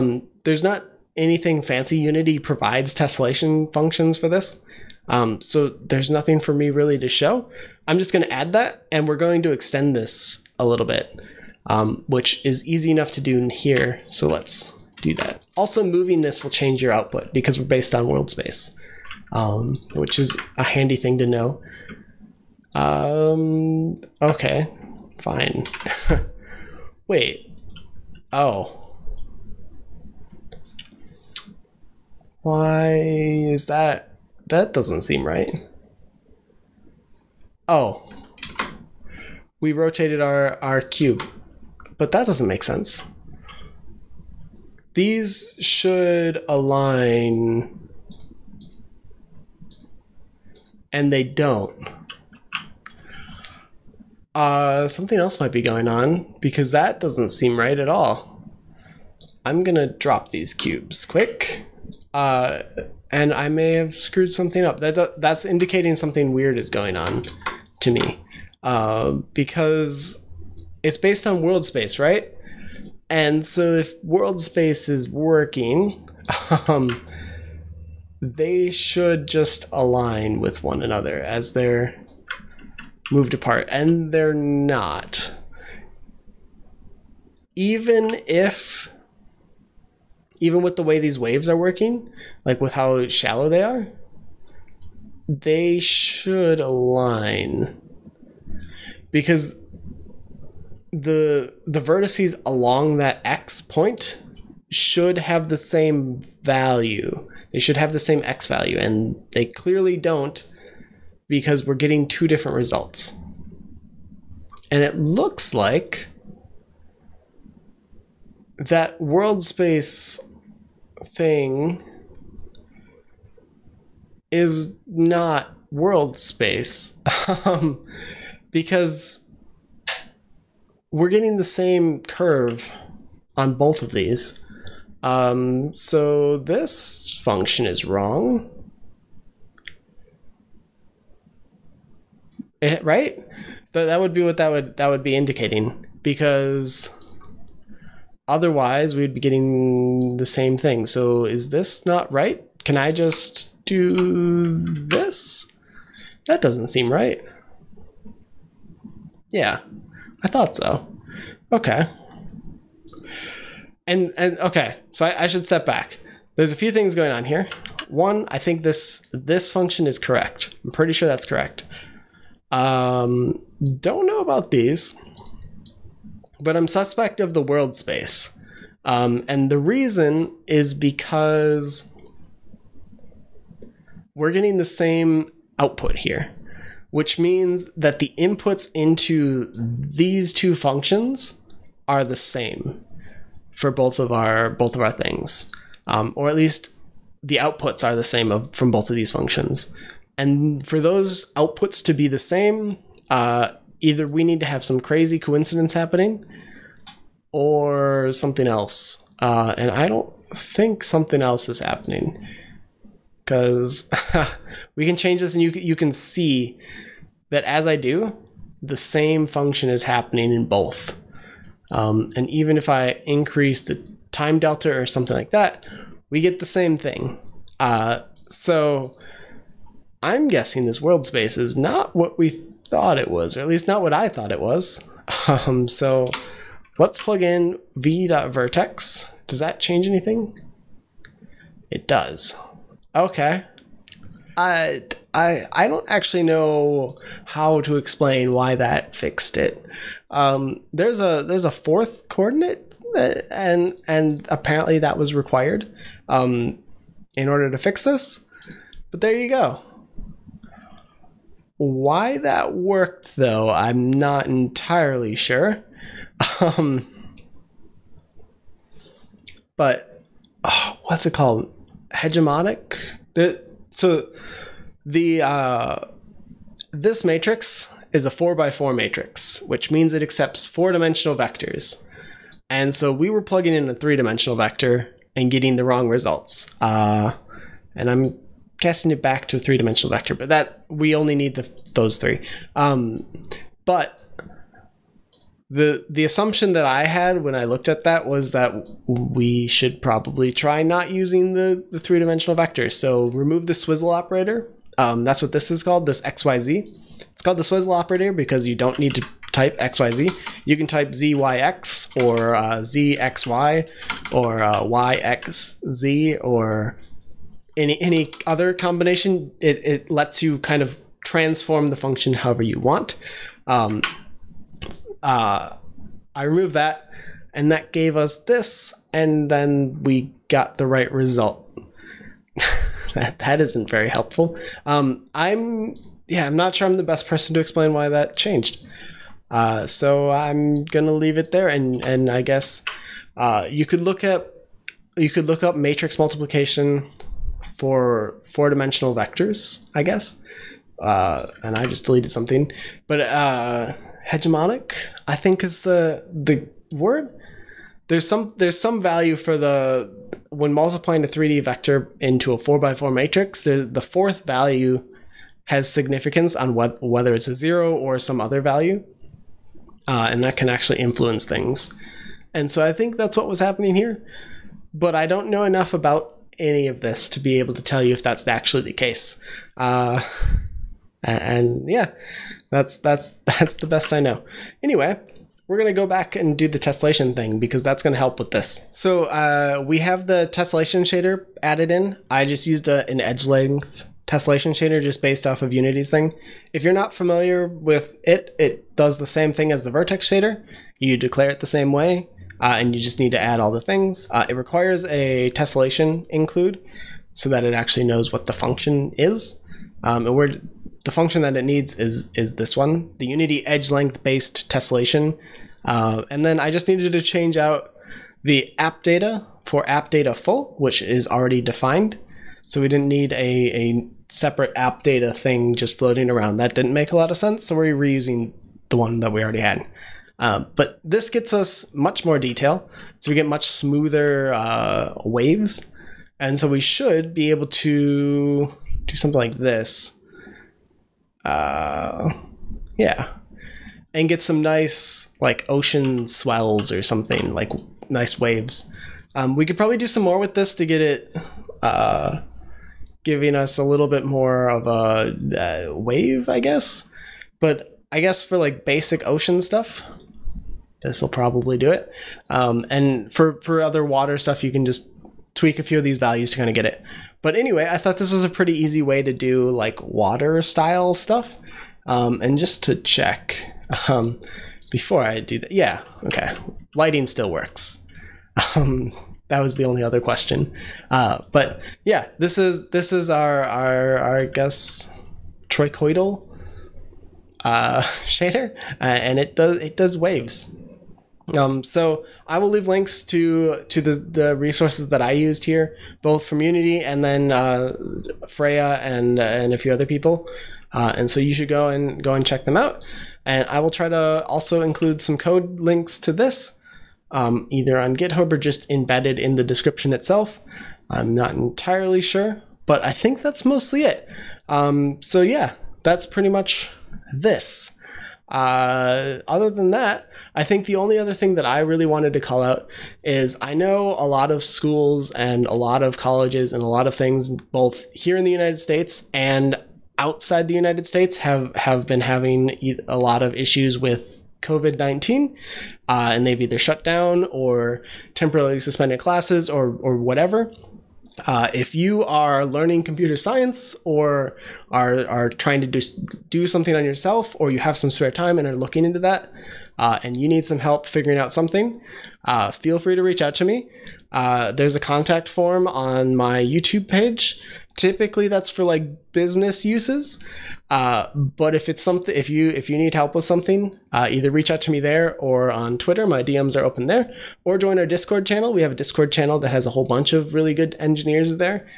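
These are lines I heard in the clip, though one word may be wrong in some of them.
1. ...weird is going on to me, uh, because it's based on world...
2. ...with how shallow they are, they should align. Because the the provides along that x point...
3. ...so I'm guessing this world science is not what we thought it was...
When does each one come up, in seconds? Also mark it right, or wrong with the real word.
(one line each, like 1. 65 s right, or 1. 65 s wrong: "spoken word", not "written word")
1. 66 s right
2. 92 s wrong: "vertices", not "provides"
3. 228 s wrong: "space", not "science".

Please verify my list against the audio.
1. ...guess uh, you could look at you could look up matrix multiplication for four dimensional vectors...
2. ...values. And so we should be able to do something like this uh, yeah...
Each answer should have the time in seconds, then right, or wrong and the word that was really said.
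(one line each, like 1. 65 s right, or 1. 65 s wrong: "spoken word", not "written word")
1. 342 s right
2. 435 s wrong: "waves", not "values".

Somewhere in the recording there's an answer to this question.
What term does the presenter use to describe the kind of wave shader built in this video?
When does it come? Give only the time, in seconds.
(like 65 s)
485 s.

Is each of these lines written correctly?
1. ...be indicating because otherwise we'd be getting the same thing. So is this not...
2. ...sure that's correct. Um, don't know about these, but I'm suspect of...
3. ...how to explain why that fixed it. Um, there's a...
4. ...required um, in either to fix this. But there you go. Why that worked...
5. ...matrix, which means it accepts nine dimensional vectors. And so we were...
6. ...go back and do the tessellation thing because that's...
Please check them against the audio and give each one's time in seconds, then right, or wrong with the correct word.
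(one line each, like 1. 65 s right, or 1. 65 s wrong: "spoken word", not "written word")
1. 145 s right
2. 170 s right
3. 247 s right
4. 255 s wrong: "order", not "either"
5. 278 s wrong: "four", not "nine"
6. 385 s right.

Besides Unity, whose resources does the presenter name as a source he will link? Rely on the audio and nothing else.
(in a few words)
Freya.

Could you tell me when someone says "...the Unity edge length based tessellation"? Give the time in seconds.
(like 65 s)
412 s.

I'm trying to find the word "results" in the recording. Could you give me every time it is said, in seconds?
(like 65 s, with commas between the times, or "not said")
112 s, 285 s, 330 s.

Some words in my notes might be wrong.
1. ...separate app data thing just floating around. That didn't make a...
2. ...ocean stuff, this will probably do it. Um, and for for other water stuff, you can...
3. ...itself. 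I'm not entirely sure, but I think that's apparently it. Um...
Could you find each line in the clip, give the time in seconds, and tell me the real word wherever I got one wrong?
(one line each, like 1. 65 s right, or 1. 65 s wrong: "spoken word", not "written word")
1. 424 s right
2. 459 s right
3. 509 s wrong: "mostly", not "apparently".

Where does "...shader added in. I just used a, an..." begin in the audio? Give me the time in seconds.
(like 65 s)
390 s.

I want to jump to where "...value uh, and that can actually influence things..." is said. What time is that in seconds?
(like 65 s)
368 s.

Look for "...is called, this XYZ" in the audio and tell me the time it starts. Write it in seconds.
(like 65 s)
305 s.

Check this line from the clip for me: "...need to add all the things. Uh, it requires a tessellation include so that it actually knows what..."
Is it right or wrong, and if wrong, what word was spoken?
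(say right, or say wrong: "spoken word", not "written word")
right.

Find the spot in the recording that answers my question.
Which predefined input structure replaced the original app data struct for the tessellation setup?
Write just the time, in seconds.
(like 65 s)
419 s.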